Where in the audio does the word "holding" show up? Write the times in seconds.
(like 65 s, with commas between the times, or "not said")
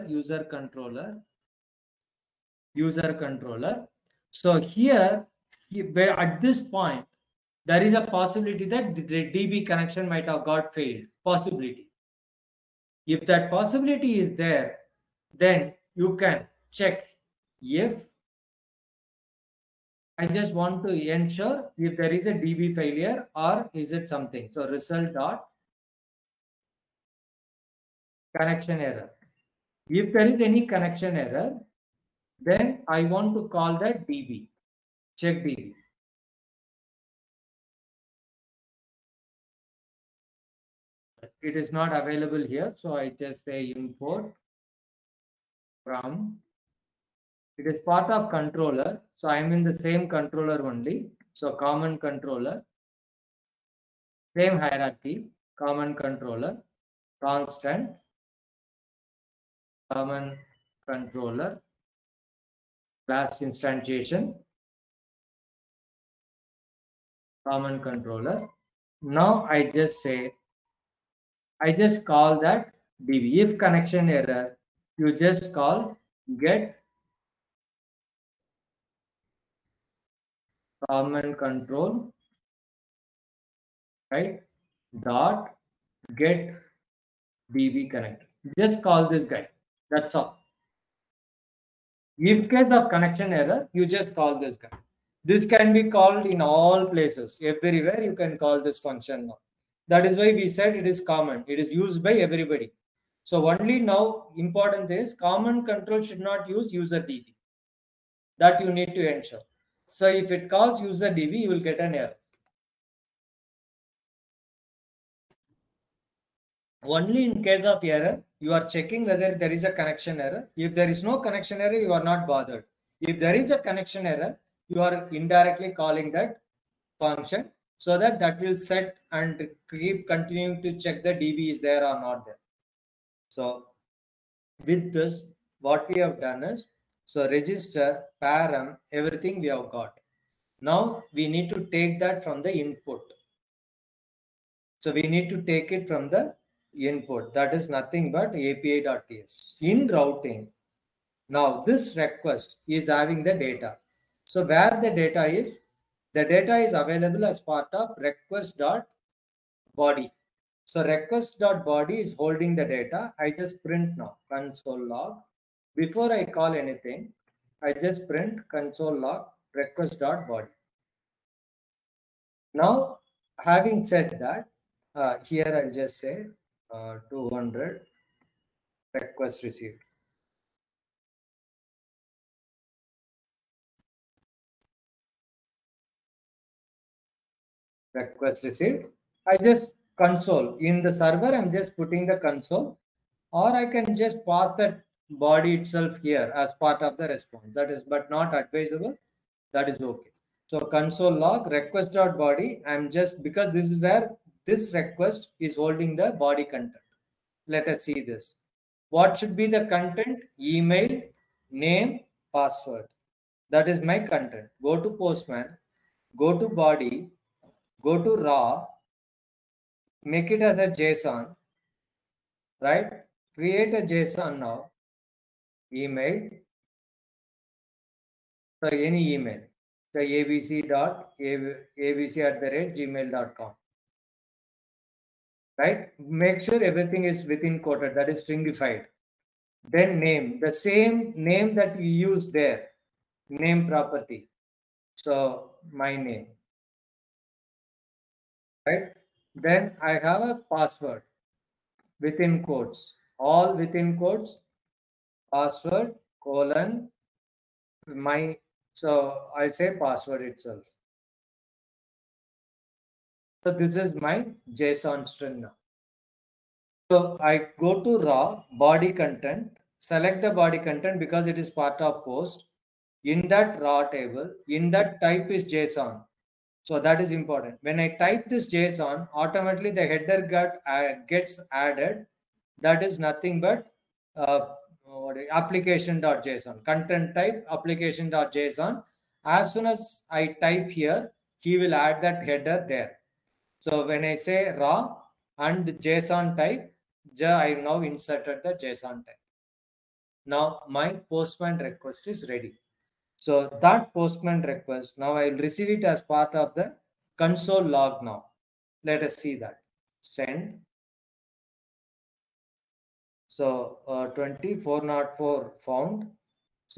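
162 s, 205 s.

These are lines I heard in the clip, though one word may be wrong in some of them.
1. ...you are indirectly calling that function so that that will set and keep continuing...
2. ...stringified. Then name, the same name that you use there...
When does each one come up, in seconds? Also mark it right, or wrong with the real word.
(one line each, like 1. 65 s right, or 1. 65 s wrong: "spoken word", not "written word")
1. 124 s right
2. 238 s right.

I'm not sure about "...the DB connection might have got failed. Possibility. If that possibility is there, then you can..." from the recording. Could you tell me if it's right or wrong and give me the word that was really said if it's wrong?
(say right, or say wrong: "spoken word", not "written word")
right.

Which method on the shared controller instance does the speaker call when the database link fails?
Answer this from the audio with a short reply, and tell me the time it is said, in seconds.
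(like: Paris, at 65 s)
get db connect, at 86 s.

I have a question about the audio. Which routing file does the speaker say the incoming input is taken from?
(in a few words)
api.ts.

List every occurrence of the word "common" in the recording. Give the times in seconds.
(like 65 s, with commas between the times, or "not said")
51 s, 55 s, 59 s, 67 s, 80 s, 101 s, 105 s.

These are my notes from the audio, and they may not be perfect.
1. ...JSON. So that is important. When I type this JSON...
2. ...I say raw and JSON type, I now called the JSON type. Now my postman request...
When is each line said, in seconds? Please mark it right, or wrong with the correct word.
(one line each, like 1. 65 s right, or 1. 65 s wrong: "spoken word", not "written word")
1. 275 s right
2. 294 s wrong: "inserted", not "called".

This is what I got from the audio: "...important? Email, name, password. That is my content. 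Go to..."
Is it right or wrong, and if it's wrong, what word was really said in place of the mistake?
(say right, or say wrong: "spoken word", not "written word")
wrong: "content", not "important".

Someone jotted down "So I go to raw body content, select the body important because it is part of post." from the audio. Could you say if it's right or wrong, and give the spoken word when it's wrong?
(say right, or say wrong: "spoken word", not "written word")
wrong: "content", not "important".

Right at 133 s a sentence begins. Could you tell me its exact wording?
So with this, what we have done is, so register, param, everything we have got.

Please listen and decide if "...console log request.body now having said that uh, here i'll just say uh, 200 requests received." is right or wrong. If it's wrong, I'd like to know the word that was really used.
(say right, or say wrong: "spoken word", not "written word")
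right.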